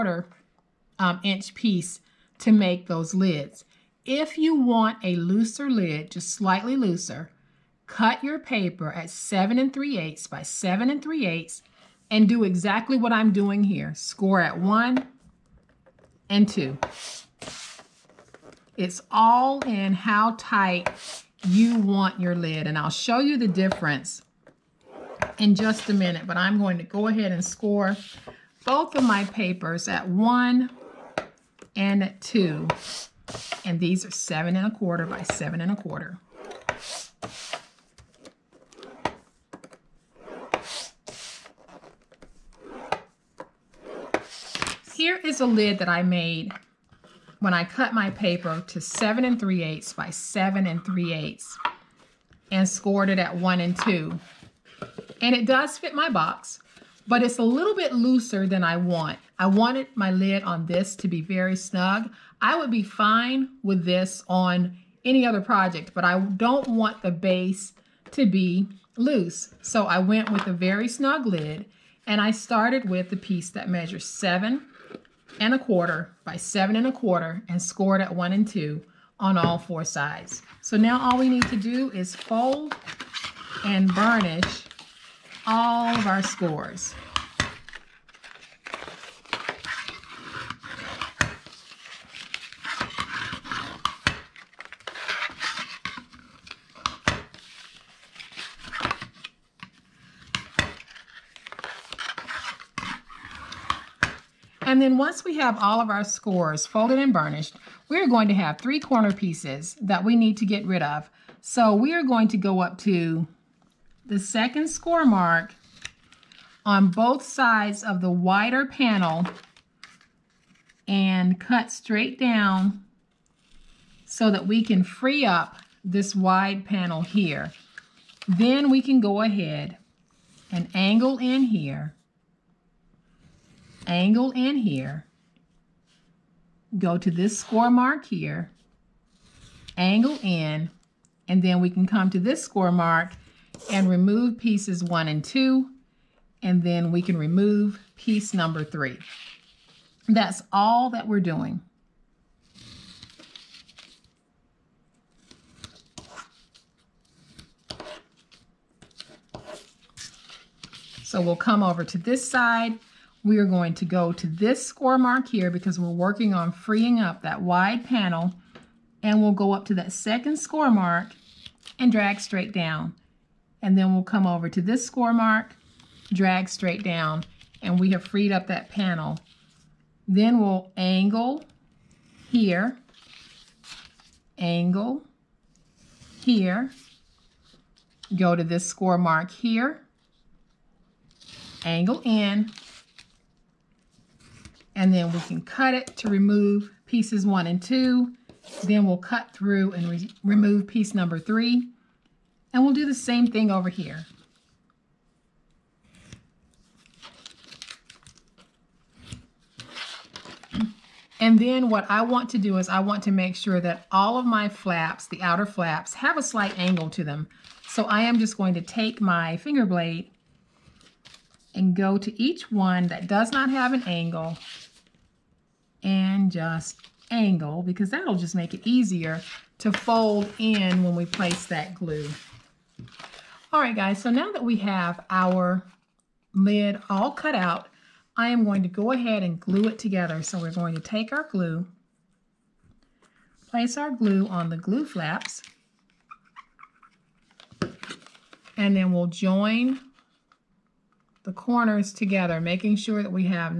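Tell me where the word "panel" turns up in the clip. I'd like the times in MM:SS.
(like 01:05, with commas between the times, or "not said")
01:58, 02:06, 02:47, 02:58.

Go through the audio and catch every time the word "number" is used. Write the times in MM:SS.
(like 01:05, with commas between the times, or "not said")
02:28, 03:20.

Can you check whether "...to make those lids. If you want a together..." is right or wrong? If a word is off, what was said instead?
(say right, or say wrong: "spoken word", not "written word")
wrong: "looser", not "together".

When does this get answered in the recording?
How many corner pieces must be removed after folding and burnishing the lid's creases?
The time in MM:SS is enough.
01:48.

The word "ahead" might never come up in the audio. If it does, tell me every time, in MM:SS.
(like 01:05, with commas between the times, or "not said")
00:27, 02:09, 03:58.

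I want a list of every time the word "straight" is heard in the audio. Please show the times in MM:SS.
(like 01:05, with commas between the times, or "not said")
02:01, 02:52, 02:56.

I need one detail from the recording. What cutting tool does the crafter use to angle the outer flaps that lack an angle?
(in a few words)
finger blade.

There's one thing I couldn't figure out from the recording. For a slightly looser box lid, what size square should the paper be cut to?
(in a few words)
7 3/8 by 7 3/8 inches.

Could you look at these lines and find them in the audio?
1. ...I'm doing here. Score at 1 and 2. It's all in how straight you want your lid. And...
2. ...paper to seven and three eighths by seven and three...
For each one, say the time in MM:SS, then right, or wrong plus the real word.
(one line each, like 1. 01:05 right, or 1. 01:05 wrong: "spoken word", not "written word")
1. 00:13 wrong: "tight", not "straight"
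2. 00:48 right.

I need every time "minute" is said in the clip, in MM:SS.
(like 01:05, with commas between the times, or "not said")
00:25.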